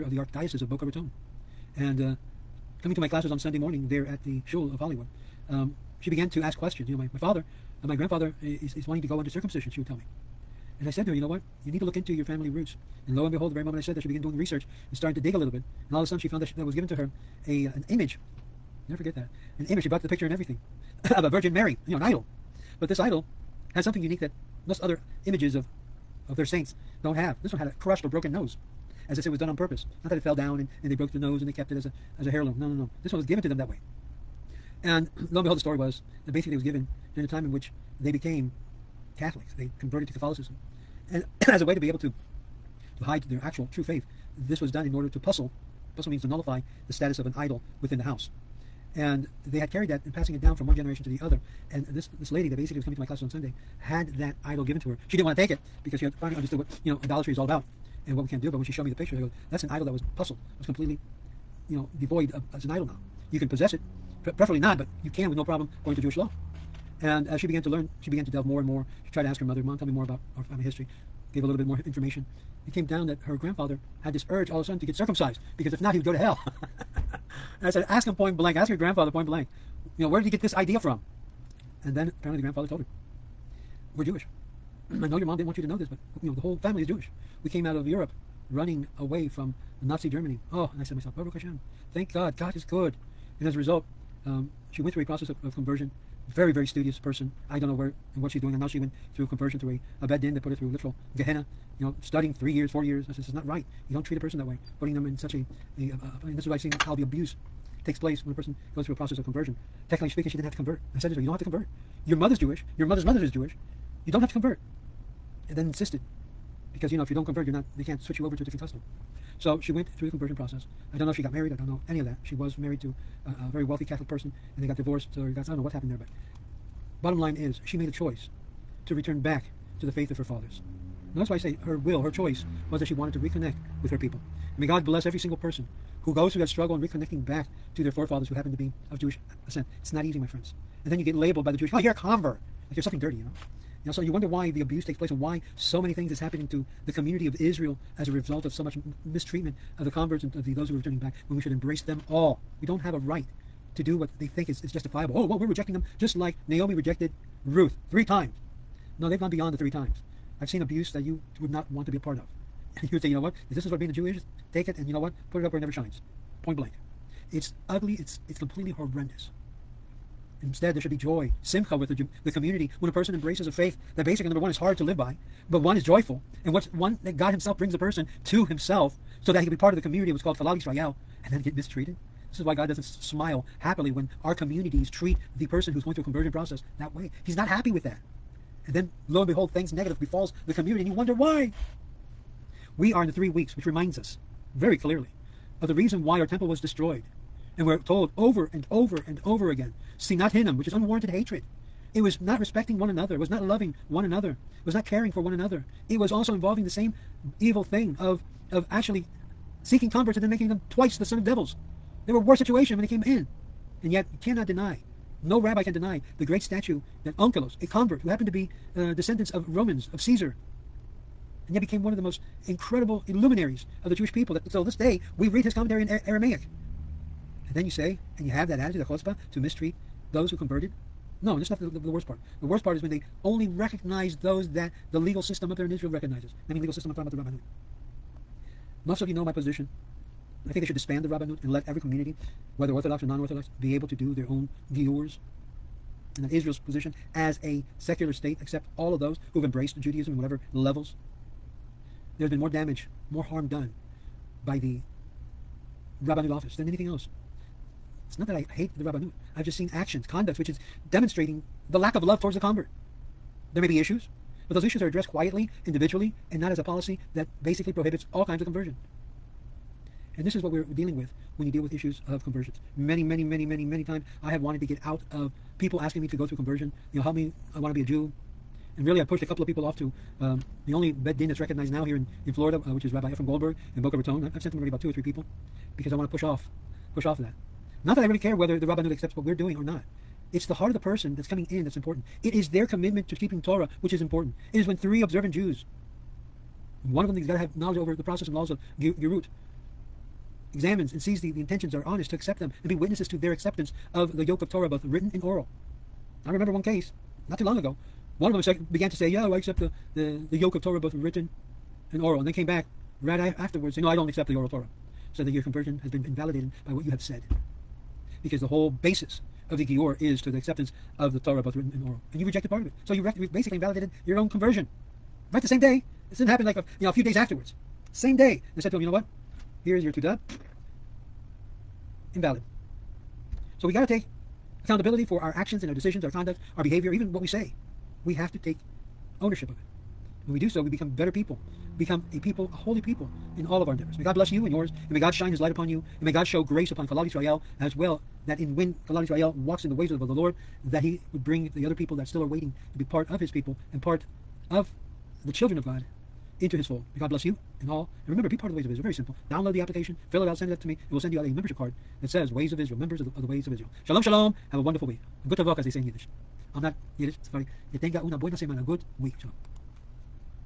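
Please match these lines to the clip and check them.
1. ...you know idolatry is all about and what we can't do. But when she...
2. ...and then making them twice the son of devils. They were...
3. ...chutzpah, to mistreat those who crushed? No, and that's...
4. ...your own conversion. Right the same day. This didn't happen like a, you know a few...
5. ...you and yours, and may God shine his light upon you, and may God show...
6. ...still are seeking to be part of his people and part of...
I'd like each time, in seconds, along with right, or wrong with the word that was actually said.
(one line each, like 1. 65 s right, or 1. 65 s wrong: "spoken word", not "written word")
1. 56 s right
2. 210 s right
3. 228 s wrong: "converted", not "crushed"
4. 324 s right
5. 344 s right
6. 352 s wrong: "waiting", not "seeking".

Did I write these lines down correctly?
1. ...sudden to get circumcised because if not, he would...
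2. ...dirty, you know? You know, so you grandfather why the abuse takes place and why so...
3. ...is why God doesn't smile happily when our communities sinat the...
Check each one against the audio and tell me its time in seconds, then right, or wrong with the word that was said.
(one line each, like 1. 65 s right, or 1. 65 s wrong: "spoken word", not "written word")
1. 74 s right
2. 142 s wrong: "wonder", not "grandfather"
3. 182 s wrong: "treat", not "sinat".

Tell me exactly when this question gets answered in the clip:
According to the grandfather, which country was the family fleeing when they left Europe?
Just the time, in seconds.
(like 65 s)
89 s.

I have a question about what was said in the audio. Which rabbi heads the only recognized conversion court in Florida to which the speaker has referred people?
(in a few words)
Rabbi Efrem Goldberg.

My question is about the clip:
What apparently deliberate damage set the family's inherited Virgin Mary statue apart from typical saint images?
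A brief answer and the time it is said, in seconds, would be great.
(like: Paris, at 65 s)
Broken nose, at 27 s.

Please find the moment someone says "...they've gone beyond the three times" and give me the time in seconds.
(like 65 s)
159 s.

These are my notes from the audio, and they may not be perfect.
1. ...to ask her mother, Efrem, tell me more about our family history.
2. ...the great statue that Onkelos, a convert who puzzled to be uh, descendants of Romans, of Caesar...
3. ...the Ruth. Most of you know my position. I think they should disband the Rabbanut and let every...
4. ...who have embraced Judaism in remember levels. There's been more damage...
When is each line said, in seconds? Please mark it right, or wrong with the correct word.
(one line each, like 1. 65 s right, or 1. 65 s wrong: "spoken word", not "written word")
1. 69 s wrong: "Mom", not "Efrem"
2. 216 s wrong: "happened", not "puzzled"
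3. 237 s wrong: "Rabbanut", not "Ruth"
4. 249 s wrong: "whatever", not "remember".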